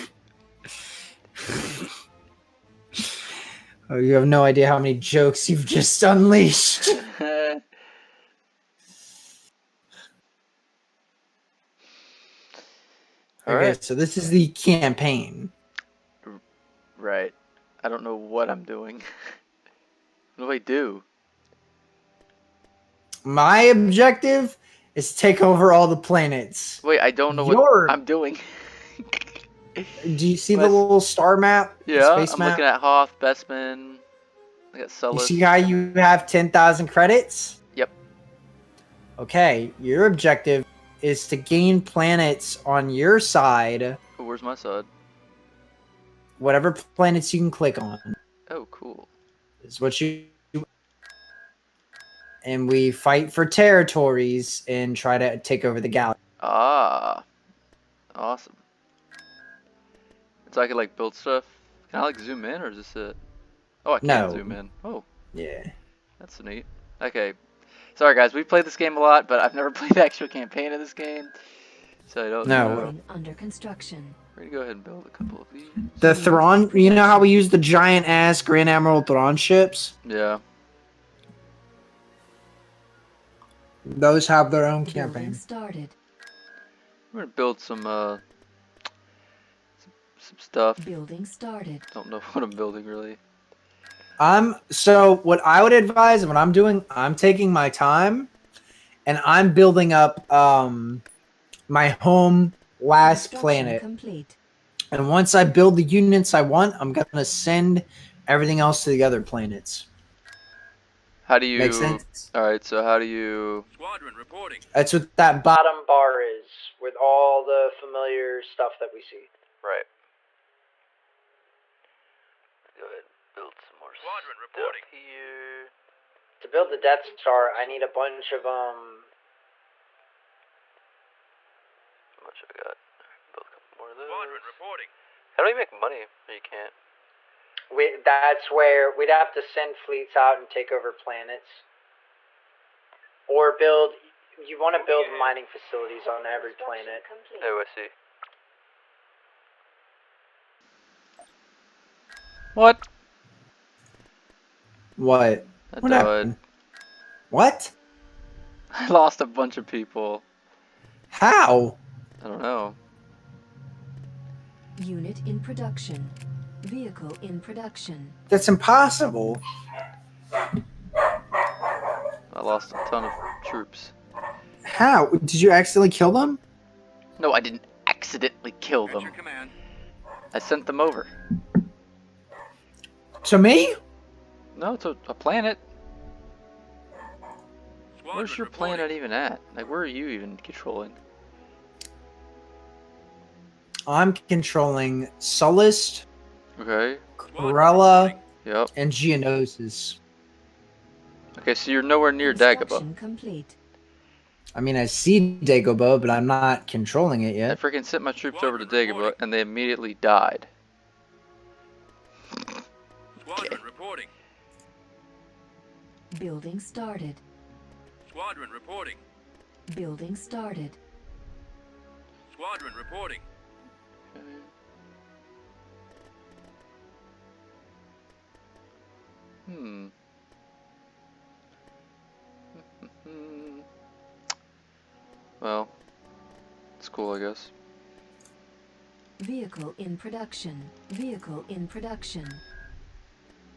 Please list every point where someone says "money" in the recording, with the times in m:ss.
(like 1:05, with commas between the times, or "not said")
2:15.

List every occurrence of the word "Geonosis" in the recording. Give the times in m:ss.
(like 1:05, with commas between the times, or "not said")
3:18.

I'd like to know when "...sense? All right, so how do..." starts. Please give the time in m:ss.
1:51.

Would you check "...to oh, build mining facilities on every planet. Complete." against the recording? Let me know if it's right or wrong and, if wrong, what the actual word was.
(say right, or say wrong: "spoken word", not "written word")
right.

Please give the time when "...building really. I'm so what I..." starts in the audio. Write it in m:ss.
1:32.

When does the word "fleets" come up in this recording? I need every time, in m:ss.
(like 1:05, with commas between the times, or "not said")
2:19.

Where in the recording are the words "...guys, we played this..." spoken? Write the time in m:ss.
1:08.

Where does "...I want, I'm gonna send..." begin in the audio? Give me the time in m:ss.
1:46.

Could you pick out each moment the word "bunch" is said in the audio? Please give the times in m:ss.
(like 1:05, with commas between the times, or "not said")
2:07, 2:39.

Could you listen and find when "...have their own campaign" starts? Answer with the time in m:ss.
1:24.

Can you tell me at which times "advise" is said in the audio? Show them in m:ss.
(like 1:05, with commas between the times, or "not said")
1:35.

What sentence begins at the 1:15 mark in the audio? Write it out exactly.
The Thrawn, you know how we use the giant ass Grand Admiral Thrawn ships?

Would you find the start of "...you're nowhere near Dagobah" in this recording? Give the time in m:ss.
3:21.